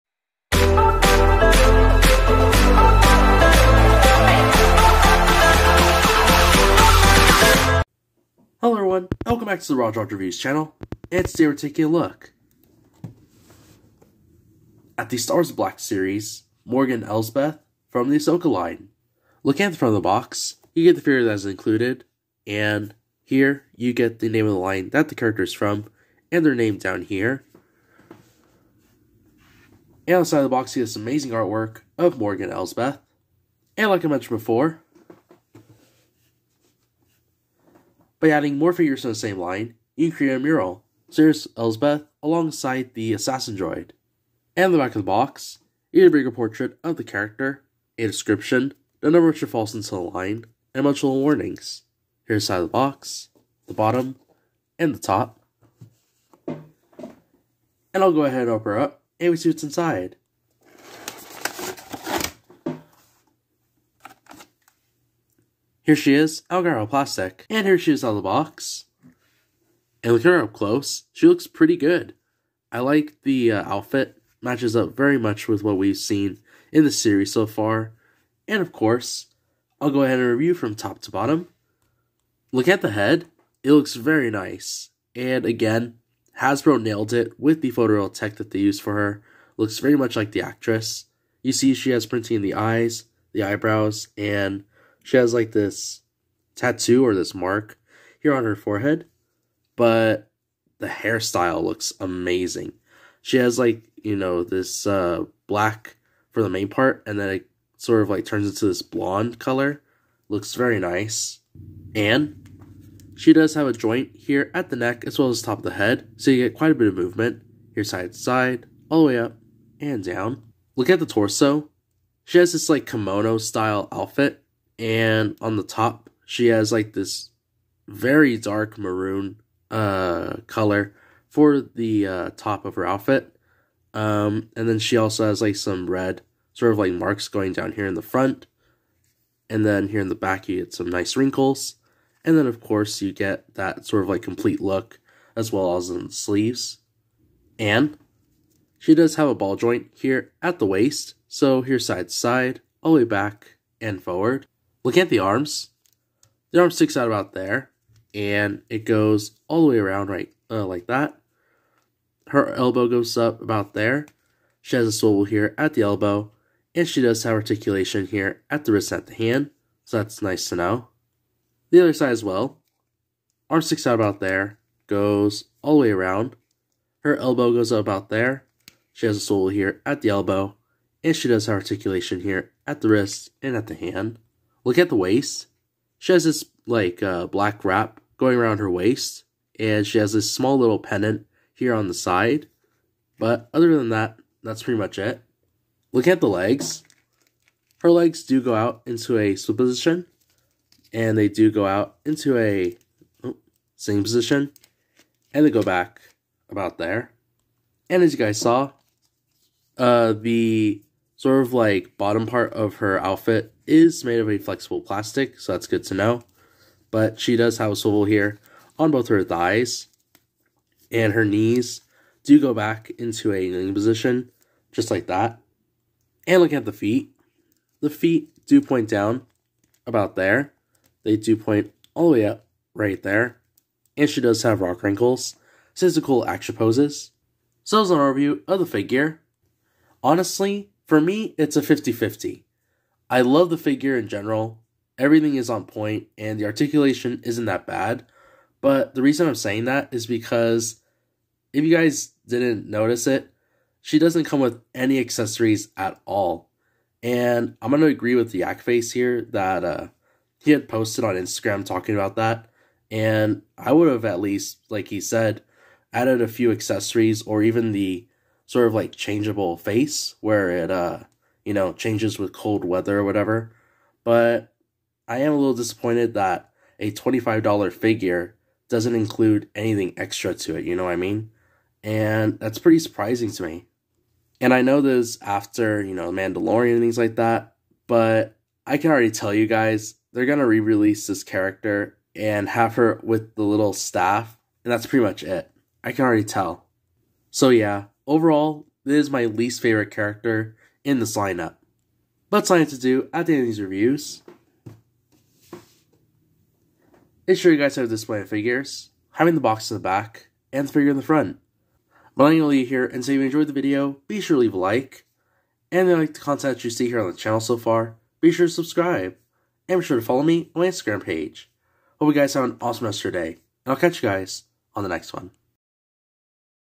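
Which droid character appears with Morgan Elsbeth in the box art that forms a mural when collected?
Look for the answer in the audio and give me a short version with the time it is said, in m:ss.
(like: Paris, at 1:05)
Assassin droid, at 0:42.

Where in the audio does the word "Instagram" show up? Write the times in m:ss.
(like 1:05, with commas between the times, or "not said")
4:21, 5:20.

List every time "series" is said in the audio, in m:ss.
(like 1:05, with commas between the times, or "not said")
0:15, 1:16.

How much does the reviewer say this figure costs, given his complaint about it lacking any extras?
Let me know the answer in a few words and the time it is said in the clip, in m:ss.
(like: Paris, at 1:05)
$25, at 4:36.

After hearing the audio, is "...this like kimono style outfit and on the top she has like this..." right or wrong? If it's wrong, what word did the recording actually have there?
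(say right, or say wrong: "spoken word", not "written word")
right.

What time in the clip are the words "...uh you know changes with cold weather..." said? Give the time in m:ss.
4:30.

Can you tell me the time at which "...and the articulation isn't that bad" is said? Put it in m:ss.
4:06.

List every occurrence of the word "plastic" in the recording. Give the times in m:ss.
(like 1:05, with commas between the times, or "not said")
1:06, 3:34.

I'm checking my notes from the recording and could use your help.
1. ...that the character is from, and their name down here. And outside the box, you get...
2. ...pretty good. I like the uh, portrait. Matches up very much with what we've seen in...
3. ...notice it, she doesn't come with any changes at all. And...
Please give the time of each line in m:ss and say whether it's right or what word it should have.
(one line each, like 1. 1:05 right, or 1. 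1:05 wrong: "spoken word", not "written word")
1. 0:24 right
2. 1:11 wrong: "outfit", not "portrait"
3. 4:12 wrong: "accessories", not "changes".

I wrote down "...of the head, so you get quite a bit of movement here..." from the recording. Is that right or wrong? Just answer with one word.
right.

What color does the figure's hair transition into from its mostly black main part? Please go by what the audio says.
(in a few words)
Blonde.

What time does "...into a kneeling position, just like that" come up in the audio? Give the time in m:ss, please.
3:42.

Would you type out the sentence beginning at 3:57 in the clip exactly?
So that was an overview of the figure.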